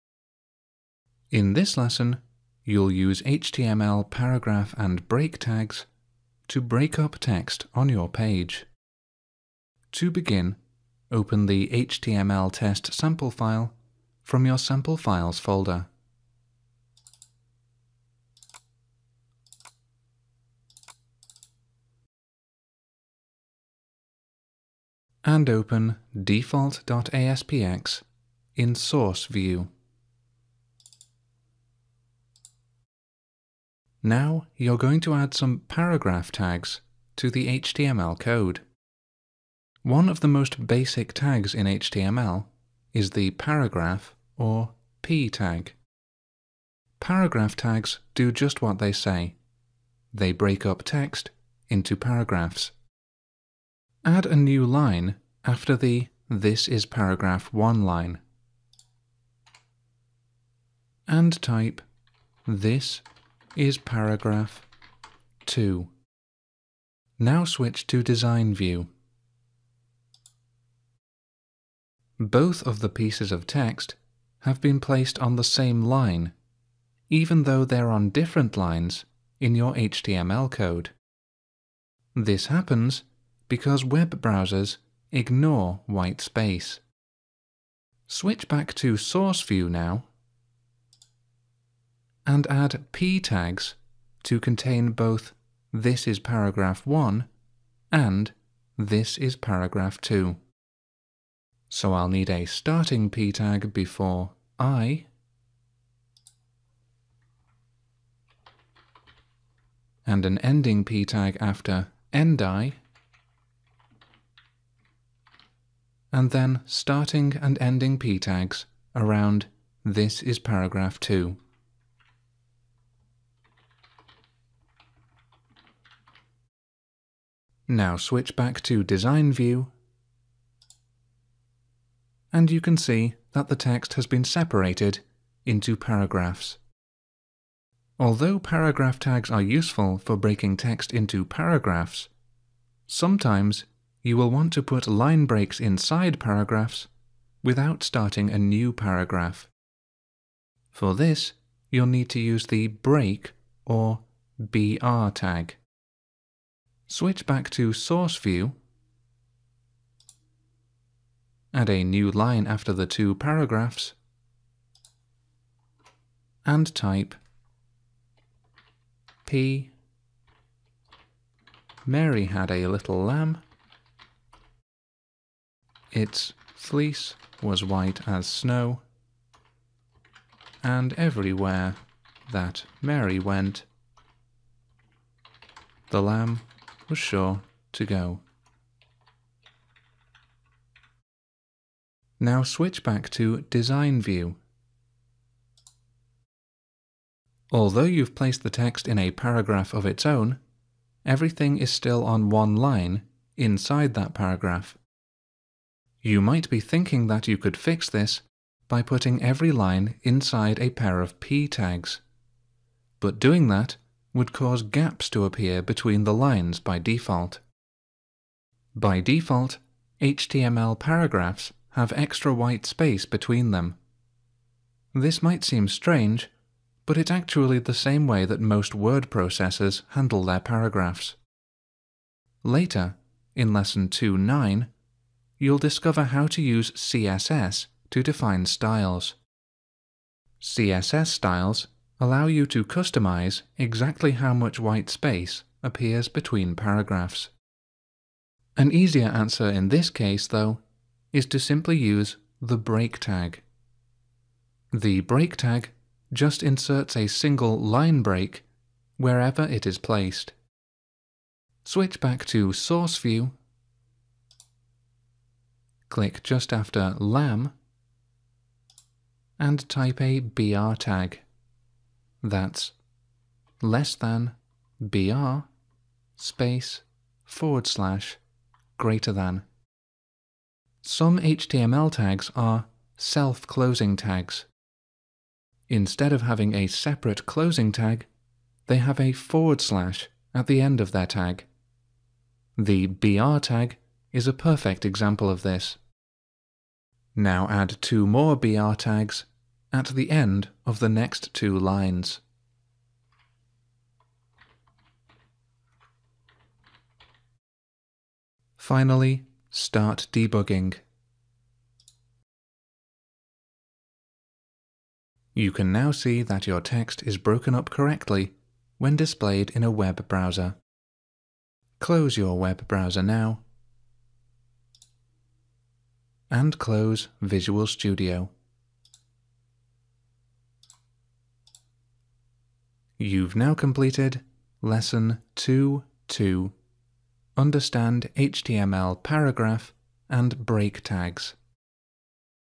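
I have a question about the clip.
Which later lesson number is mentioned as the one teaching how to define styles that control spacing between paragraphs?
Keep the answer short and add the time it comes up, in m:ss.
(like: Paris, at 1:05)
2.9, at 3:53.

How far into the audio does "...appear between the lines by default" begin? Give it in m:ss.
3:35.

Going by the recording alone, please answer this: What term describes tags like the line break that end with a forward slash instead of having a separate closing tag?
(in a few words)
self-closing tags.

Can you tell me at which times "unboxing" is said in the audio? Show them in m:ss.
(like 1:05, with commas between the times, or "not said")
not said.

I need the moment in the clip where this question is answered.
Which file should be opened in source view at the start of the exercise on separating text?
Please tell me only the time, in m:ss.
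0:26.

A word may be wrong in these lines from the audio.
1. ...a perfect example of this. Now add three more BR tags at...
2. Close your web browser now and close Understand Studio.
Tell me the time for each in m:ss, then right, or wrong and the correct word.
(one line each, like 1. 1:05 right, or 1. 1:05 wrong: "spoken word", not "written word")
1. 4:54 wrong: "two", not "three"
2. 5:21 wrong: "Visual", not "Understand".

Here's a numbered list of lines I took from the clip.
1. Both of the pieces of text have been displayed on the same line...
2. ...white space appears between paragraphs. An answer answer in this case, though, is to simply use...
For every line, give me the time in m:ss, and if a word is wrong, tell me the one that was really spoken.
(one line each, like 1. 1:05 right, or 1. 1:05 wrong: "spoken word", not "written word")
1. 1:12 wrong: "placed", not "displayed"
2. 4:04 wrong: "easier", not "answer".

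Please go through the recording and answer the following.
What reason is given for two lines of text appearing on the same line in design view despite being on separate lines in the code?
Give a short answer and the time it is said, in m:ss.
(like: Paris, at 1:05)
Web browsers ignore white space, at 1:23.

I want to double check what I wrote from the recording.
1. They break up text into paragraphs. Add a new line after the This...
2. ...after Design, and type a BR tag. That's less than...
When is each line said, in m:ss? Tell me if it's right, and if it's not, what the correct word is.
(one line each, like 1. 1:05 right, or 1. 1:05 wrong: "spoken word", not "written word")
1. 0:50 right
2. 4:26 wrong: "LAM", not "Design".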